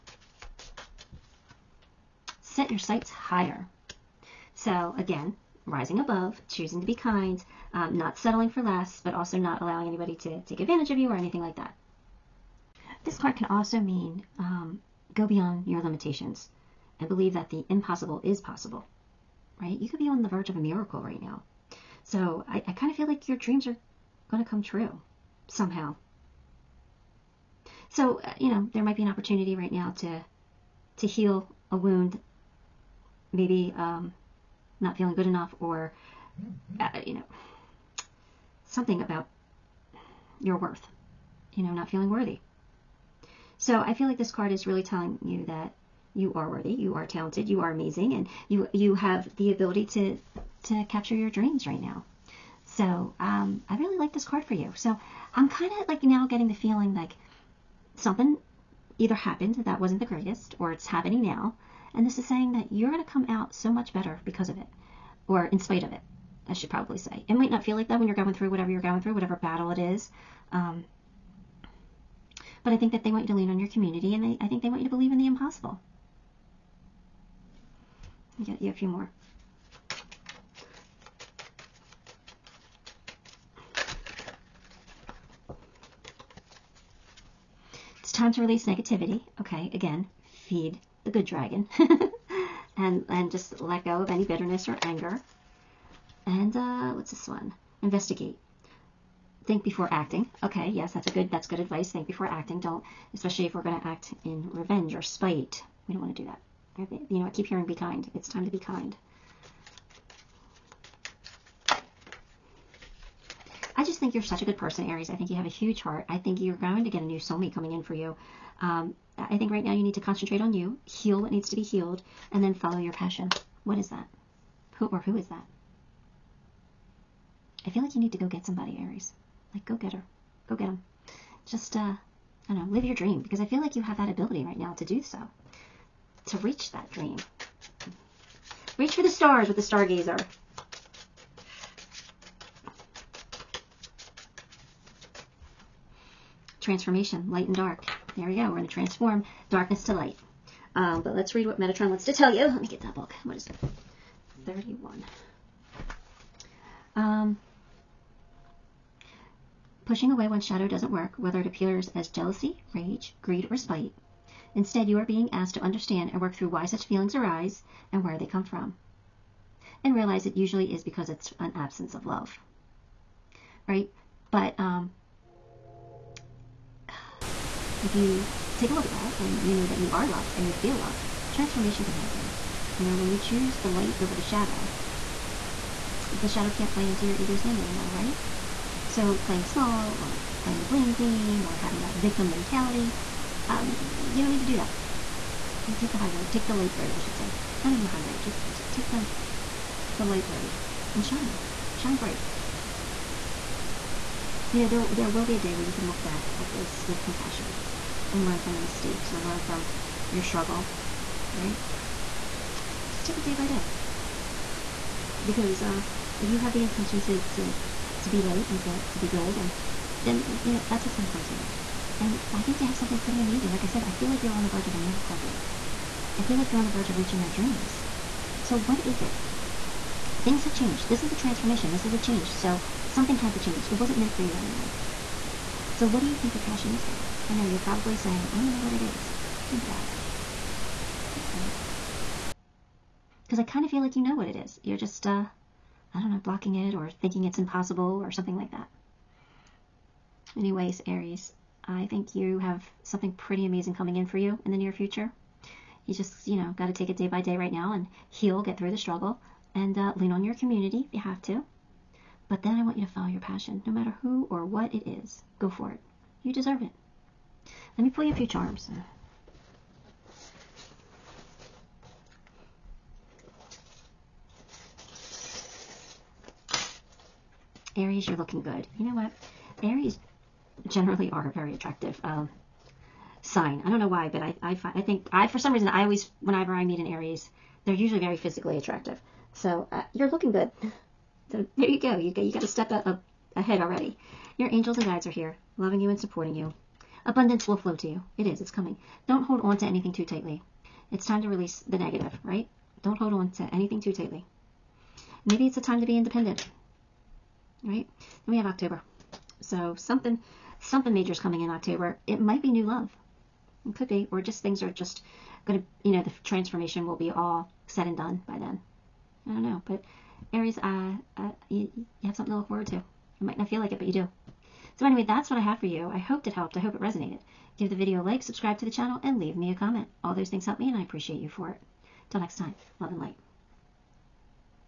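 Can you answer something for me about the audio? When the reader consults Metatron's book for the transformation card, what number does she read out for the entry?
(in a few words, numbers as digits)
31.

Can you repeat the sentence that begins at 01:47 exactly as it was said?
keep hearing be kind it's time to be kind I just think you're such a good person, Aries.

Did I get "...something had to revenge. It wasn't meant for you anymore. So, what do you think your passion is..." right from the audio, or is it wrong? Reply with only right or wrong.
wrong.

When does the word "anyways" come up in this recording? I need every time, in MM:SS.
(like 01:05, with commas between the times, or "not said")
04:10, 05:24.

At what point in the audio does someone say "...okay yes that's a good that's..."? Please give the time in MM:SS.
01:40.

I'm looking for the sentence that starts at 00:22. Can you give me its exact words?
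So I, I kind of feel like your dreams are going to come true somehow.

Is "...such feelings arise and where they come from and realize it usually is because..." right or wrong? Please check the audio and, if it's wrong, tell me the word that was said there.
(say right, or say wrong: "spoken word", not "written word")
right.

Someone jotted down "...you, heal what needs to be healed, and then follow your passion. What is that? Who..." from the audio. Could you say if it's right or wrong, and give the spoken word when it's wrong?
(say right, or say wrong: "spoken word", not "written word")
right.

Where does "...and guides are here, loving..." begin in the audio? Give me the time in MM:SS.
04:54.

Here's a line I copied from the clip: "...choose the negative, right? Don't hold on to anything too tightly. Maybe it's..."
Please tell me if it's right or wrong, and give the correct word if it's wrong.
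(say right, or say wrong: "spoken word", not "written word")
wrong: "release", not "choose".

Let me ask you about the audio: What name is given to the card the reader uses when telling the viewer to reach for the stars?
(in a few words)
stargazer.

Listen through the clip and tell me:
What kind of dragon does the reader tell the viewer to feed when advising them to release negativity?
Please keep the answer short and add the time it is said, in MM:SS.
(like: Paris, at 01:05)
the good dragon, at 01:31.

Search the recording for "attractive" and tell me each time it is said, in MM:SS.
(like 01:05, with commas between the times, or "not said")
04:41, 04:48.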